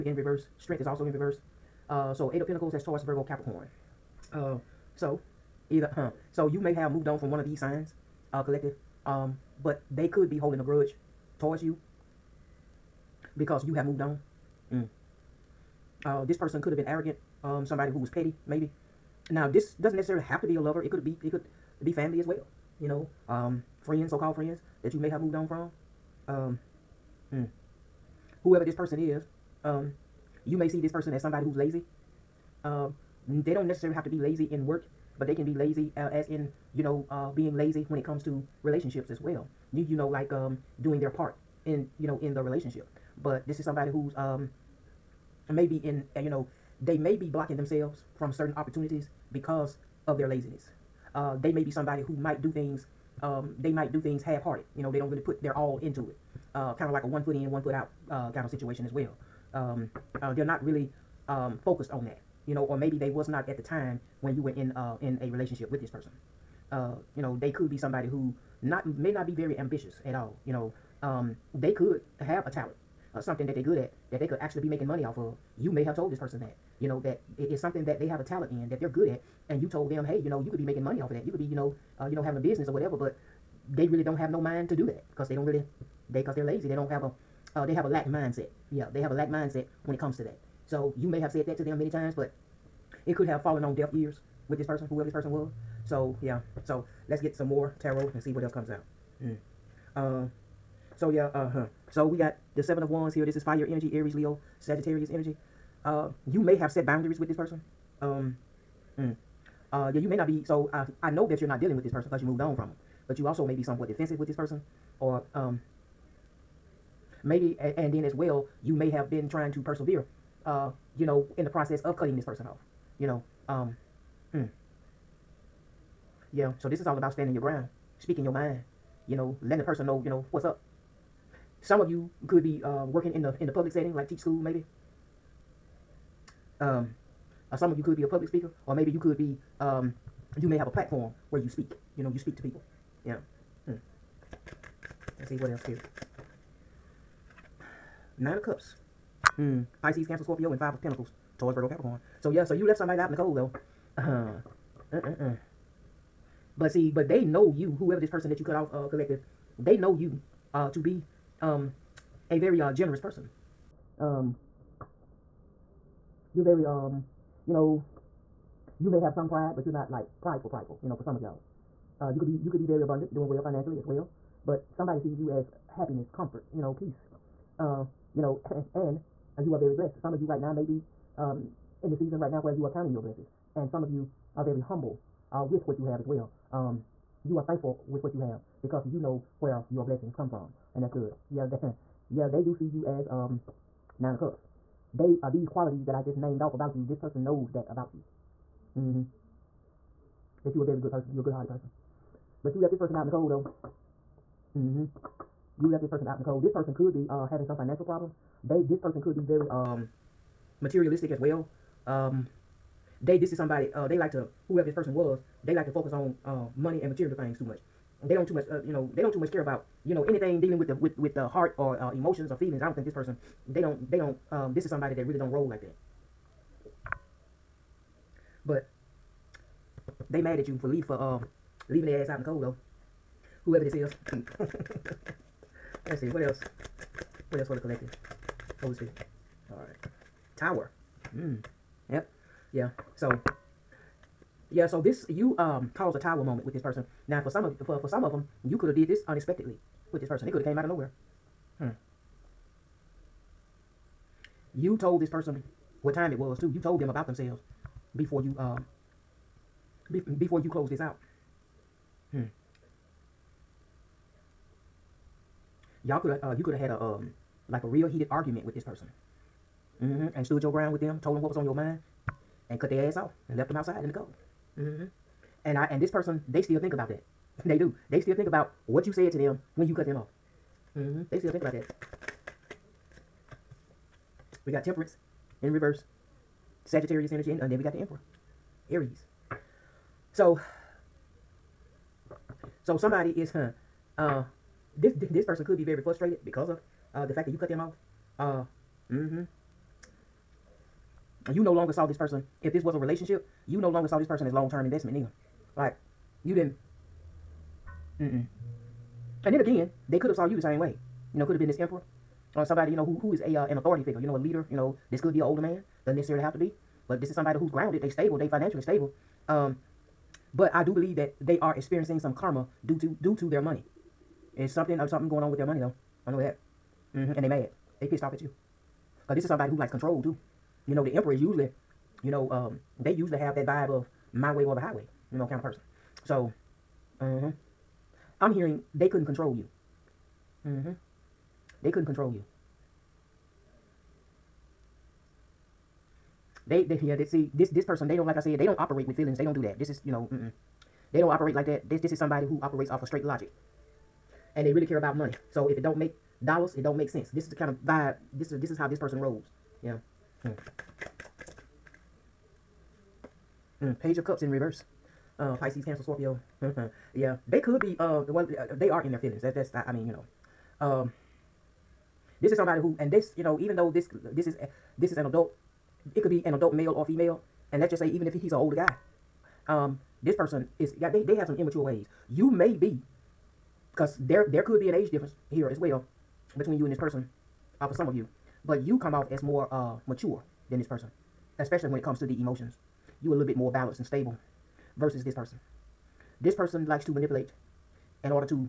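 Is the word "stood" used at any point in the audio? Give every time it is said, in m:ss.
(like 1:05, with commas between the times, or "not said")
4:30.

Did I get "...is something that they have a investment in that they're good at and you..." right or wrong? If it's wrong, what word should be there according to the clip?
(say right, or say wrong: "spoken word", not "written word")
wrong: "talent", not "investment".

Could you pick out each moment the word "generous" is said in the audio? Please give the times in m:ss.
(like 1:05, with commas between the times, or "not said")
2:42.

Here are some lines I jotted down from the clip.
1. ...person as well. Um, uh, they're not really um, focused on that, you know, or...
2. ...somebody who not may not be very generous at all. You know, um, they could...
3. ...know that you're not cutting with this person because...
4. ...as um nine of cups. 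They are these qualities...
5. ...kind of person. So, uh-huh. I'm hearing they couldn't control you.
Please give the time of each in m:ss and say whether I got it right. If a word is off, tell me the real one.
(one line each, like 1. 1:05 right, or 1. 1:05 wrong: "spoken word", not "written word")
1. 0:58 wrong: "situation", not "person"
2. 1:07 wrong: "ambitious", not "generous"
3. 1:51 wrong: "dealing", not "cutting"
4. 3:12 right
5. 5:35 right.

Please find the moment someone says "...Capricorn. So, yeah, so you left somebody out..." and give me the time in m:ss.
2:31.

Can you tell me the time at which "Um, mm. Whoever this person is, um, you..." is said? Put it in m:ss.
0:26.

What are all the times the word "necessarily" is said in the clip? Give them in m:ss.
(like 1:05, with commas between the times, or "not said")
0:19, 0:33, 5:15.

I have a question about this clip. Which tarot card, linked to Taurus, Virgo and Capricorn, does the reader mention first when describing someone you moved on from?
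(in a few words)
Eight of Pentacles.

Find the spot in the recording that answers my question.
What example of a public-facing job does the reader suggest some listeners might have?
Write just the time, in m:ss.
2:14.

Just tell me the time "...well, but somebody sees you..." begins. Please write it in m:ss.
2:53.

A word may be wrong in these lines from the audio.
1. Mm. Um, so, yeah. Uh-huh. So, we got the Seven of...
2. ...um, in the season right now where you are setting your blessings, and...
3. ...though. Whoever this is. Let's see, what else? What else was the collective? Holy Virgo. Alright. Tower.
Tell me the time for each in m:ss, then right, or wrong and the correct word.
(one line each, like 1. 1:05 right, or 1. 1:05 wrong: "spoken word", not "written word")
1. 1:39 right
2. 3:01 wrong: "counting", not "setting"
3. 3:52 wrong: "Spirit", not "Virgo".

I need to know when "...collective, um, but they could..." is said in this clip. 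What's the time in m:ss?
0:08.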